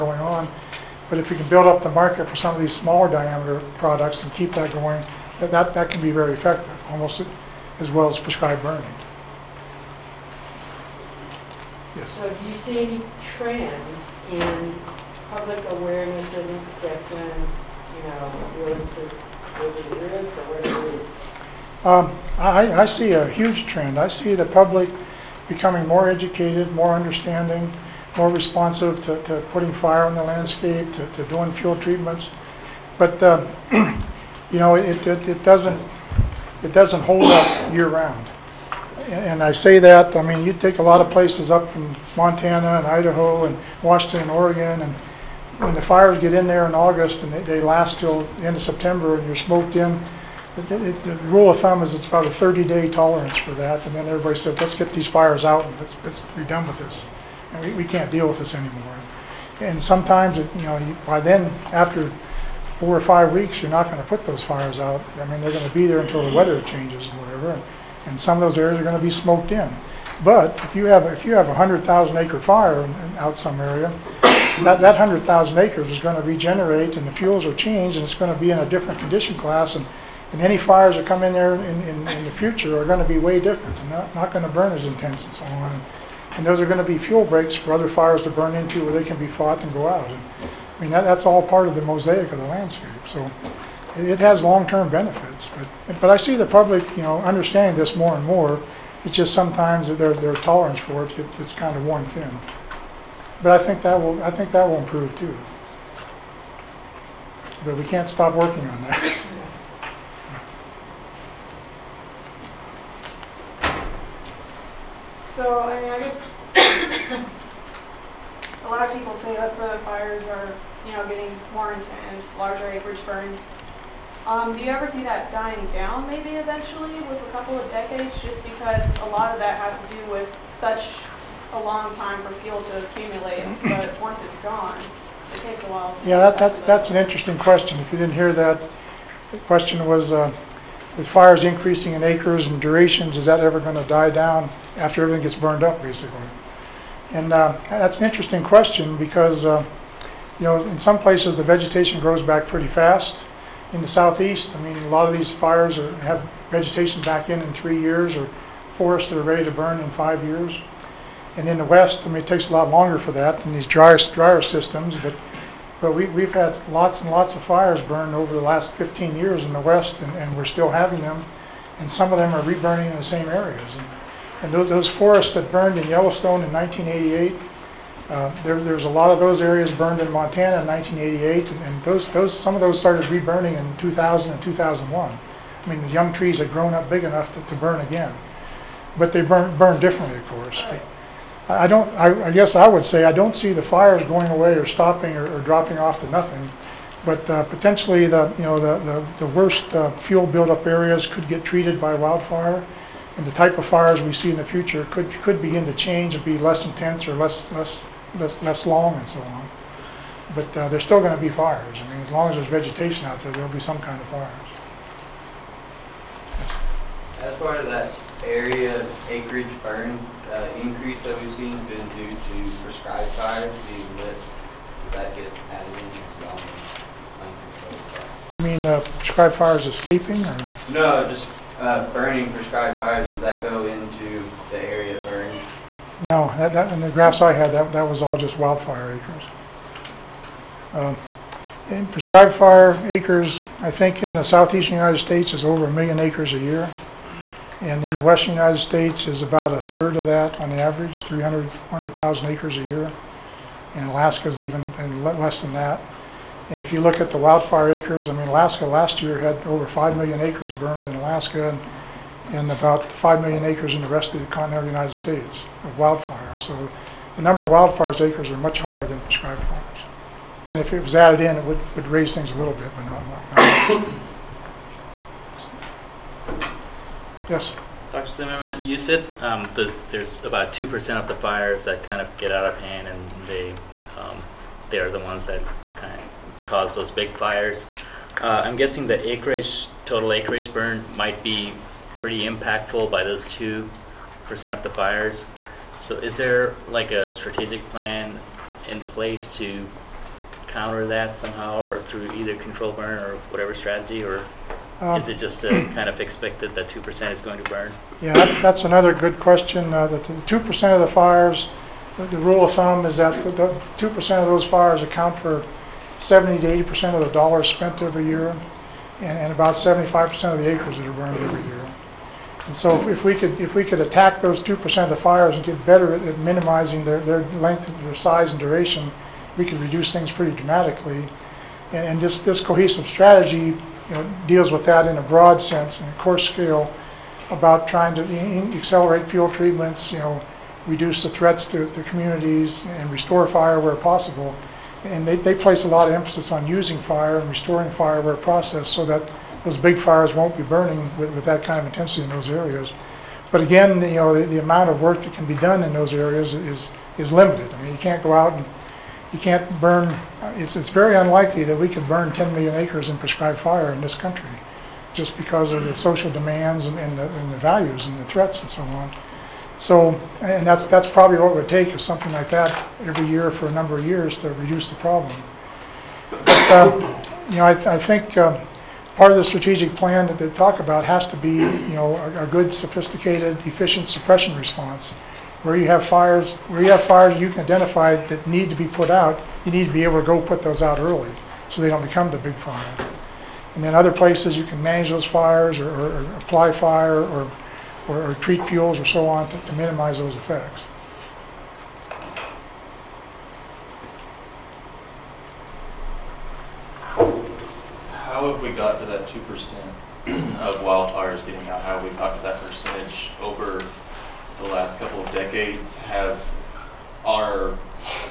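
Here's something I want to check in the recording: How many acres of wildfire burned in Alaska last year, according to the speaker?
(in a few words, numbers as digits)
over 5 million.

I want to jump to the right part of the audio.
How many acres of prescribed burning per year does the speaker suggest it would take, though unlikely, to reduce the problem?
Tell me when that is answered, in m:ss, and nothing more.
6:02.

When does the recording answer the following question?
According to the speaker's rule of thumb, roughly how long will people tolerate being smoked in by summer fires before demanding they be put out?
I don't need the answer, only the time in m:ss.
0:52.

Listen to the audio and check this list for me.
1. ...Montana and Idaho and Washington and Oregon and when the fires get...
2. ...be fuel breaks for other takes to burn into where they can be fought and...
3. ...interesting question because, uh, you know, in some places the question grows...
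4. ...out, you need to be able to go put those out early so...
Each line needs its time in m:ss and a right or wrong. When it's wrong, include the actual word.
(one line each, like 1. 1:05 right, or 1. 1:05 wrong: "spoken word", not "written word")
1. 0:42 right
2. 1:26 wrong: "fires", not "takes"
3. 2:28 wrong: "vegetation", not "question"
4. 6:28 right.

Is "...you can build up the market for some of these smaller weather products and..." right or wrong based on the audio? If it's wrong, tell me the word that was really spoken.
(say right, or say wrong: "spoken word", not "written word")
wrong: "diameter", not "weather".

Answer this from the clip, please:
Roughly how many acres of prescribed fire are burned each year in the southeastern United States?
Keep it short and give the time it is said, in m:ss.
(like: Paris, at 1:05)
over 1 million acres, at 4:05.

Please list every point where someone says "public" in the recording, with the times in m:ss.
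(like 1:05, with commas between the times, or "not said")
0:15, 0:24, 1:36.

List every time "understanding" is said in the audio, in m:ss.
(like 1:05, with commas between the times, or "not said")
0:26, 1:37.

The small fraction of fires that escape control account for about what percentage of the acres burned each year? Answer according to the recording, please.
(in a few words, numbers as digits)
75%.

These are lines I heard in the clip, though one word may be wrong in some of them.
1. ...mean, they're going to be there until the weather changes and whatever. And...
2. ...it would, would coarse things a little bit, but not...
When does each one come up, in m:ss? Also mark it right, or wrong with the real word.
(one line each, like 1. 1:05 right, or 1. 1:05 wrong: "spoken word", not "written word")
1. 1:05 right
2. 4:31 wrong: "raise", not "coarse".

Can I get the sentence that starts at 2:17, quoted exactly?
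If you didn't hear that, the question was.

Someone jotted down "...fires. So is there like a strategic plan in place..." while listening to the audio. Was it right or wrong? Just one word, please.
right.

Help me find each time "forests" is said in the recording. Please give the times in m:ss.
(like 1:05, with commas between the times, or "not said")
2:38, 2:54.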